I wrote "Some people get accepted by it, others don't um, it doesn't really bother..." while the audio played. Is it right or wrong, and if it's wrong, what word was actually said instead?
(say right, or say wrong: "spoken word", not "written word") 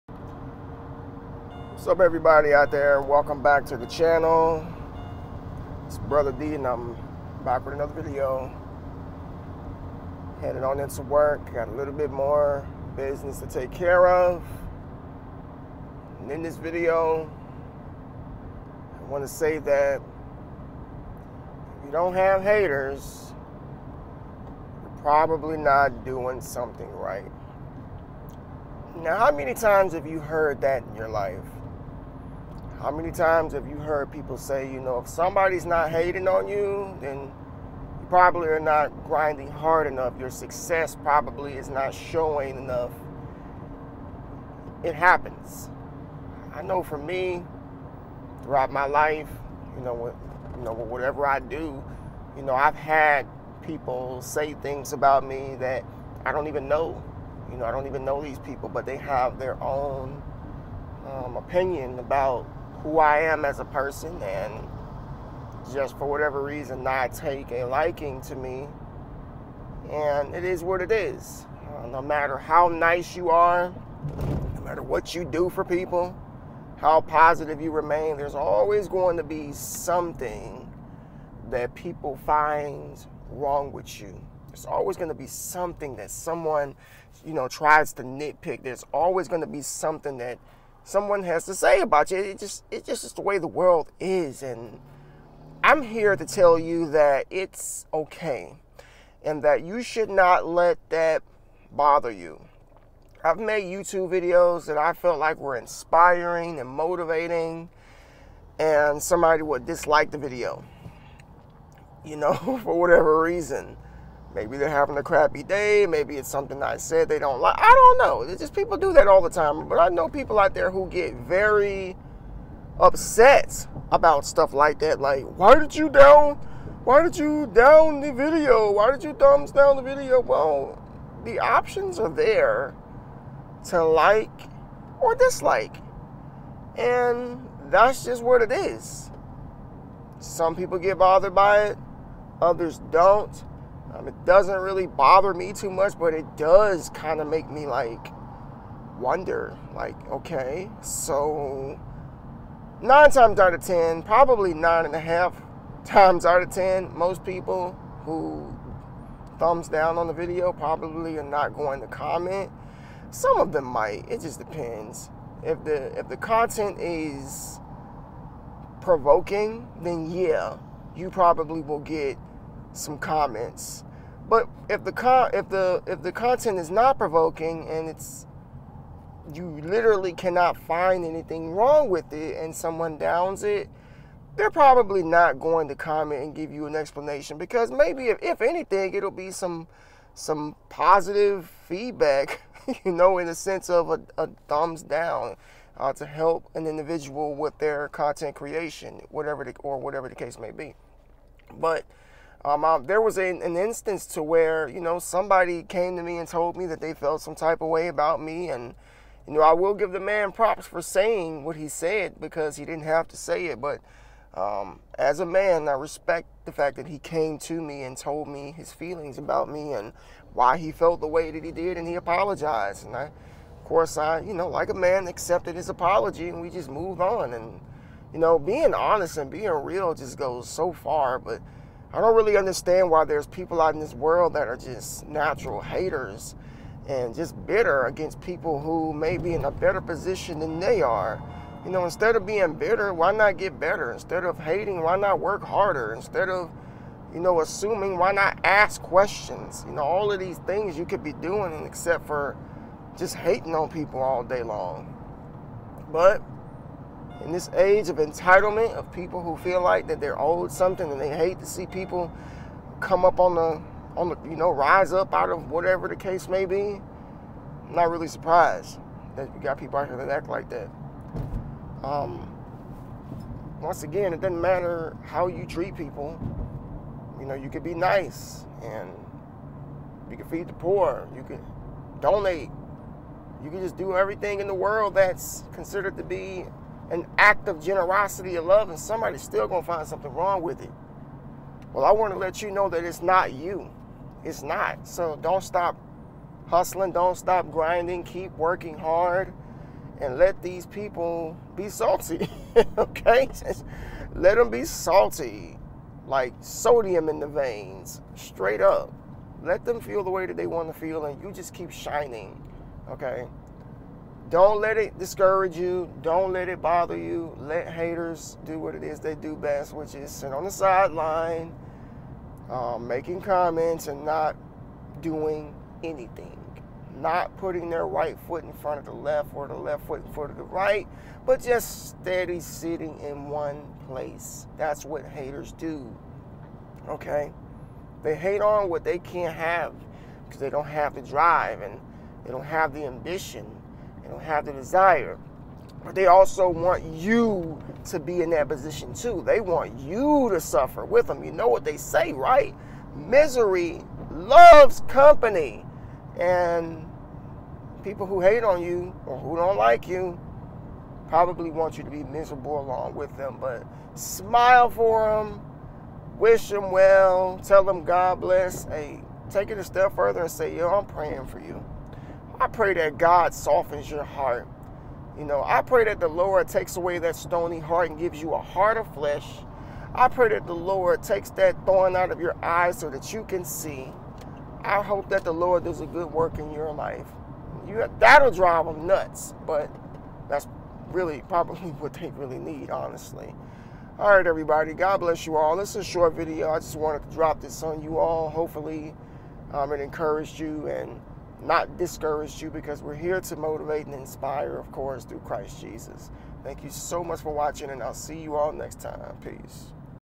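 wrong: "bothered", not "accepted".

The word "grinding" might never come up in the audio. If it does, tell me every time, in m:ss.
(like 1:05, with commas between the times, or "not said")
0:39, 4:57.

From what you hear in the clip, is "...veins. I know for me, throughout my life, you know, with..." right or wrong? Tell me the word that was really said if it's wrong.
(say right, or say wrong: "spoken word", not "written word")
wrong: "happens", not "veins".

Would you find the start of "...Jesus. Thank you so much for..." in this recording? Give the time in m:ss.
6:45.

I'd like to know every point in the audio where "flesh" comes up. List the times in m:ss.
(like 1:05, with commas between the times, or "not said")
6:18.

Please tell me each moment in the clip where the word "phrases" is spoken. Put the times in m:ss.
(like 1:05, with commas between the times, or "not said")
not said.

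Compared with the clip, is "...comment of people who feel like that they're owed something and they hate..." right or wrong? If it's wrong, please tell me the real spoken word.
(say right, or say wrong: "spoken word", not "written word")
wrong: "entitlement", not "comment".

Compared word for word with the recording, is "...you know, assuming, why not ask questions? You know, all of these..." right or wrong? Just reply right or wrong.
right.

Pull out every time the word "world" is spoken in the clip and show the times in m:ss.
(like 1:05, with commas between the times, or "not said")
1:33, 3:53, 4:44.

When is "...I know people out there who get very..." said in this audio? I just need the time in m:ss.
1:59.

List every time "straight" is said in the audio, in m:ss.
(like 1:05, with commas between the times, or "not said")
5:08.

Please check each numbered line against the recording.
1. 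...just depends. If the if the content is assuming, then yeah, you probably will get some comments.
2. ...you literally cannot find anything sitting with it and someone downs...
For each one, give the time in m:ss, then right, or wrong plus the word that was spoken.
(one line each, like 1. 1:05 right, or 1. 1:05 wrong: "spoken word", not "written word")
1. 2:44 wrong: "provoking", not "assuming"
2. 2:59 wrong: "wrong", not "sitting".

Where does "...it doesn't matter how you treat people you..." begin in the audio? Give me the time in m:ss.
4:34.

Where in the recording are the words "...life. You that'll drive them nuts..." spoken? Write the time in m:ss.
6:26.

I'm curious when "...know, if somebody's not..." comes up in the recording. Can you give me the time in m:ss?
0:34.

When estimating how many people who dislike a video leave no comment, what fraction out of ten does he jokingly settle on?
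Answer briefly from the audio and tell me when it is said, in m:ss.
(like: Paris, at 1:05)
9.5, at 2:34.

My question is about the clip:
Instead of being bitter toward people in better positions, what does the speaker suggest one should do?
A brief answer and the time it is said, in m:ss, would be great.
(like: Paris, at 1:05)
get better, at 4:03.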